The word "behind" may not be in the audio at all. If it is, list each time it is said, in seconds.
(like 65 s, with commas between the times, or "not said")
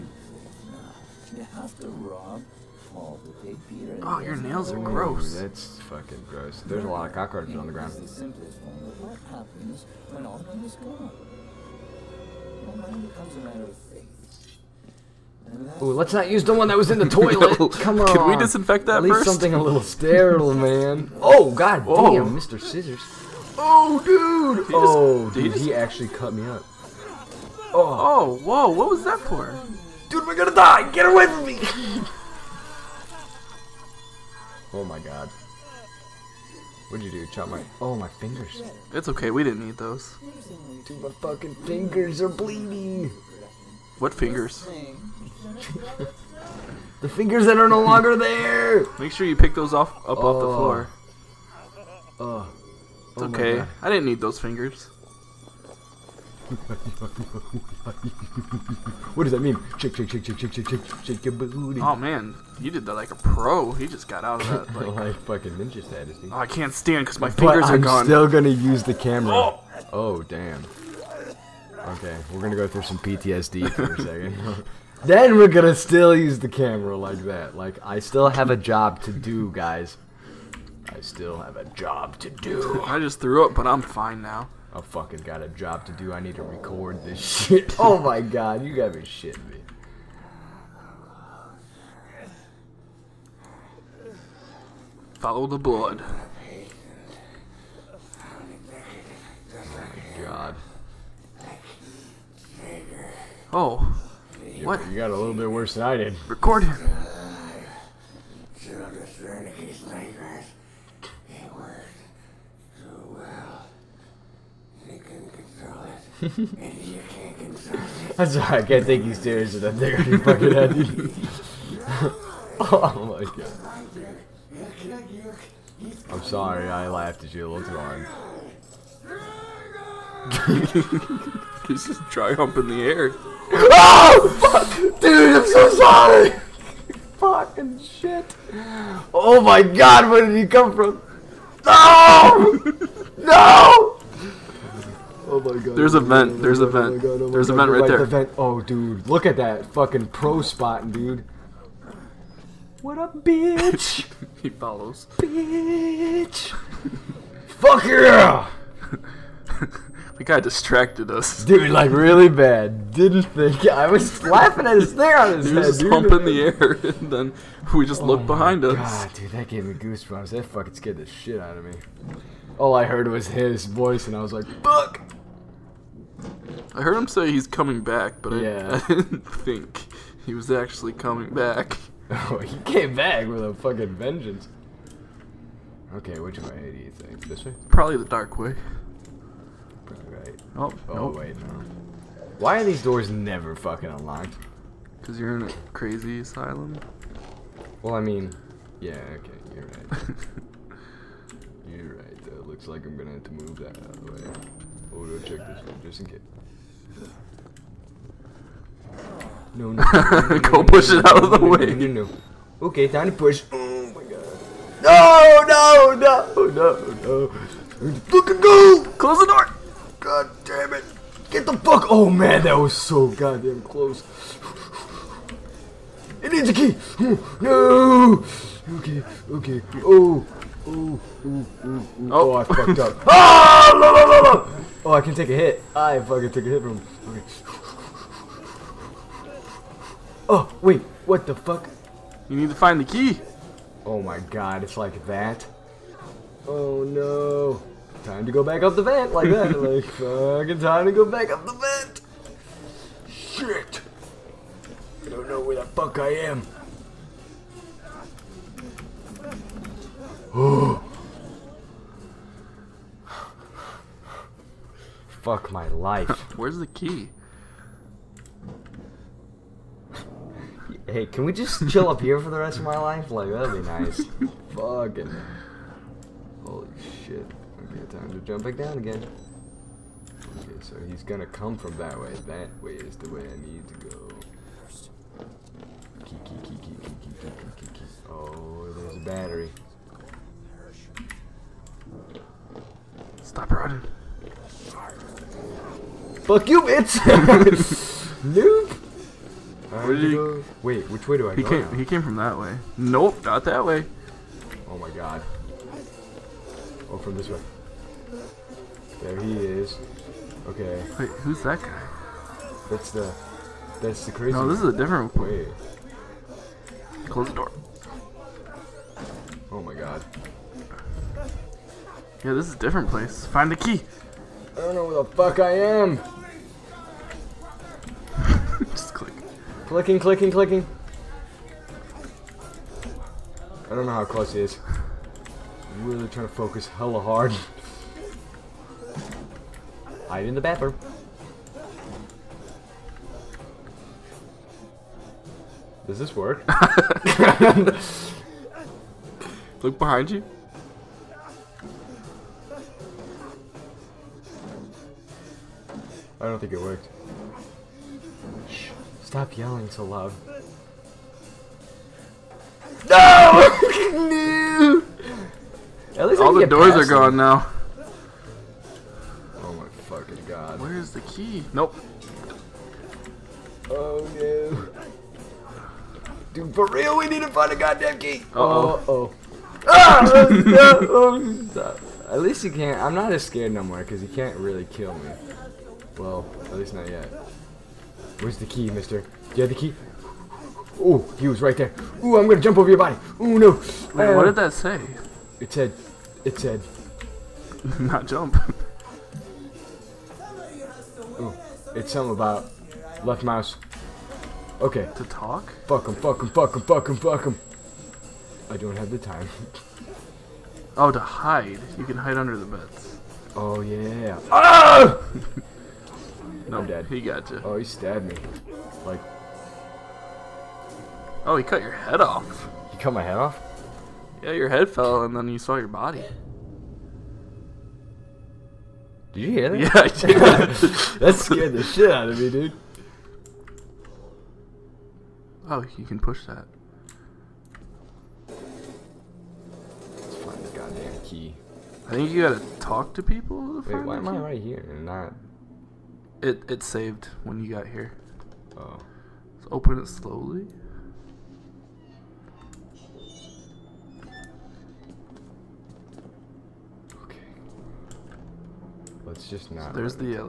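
168 s, 349 s.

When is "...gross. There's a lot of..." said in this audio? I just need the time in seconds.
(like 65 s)
6 s.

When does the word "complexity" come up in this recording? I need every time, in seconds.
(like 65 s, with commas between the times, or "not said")
not said.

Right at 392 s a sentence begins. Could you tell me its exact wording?
Ooh, I'm gonna jump over your body.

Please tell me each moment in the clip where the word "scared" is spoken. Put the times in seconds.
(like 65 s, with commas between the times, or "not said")
170 s, 383 s, 431 s.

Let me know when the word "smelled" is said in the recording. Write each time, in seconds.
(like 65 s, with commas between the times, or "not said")
not said.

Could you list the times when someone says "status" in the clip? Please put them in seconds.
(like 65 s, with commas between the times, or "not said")
65 s.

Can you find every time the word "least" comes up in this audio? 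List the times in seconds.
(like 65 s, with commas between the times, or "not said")
19 s, 366 s, 382 s, 386 s.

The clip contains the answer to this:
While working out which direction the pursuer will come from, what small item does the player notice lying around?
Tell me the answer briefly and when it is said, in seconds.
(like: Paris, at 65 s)
a battery, at 288 s.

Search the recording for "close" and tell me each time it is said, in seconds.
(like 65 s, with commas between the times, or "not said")
218 s, 223 s, 317 s, 334 s.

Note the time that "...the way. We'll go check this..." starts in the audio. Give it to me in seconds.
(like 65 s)
204 s.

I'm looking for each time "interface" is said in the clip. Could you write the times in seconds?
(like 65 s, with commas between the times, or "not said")
not said.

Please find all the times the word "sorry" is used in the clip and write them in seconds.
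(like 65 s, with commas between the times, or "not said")
126 s, 135 s.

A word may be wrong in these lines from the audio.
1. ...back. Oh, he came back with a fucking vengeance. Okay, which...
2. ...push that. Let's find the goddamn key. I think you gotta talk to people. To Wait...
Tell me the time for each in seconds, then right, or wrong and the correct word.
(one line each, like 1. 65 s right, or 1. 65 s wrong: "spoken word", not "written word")
1. 181 s right
2. 435 s right.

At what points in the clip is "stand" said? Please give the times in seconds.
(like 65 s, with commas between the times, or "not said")
66 s.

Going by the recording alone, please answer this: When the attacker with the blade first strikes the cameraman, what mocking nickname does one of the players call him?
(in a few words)
Mr. Scissors.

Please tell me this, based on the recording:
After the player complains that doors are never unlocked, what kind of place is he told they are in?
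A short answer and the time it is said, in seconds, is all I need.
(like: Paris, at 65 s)
crazy asylum, at 195 s.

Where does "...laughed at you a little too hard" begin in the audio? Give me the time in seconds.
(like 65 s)
126 s.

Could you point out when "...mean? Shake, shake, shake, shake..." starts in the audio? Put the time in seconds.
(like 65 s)
59 s.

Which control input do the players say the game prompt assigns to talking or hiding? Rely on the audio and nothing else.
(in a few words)
left mouse.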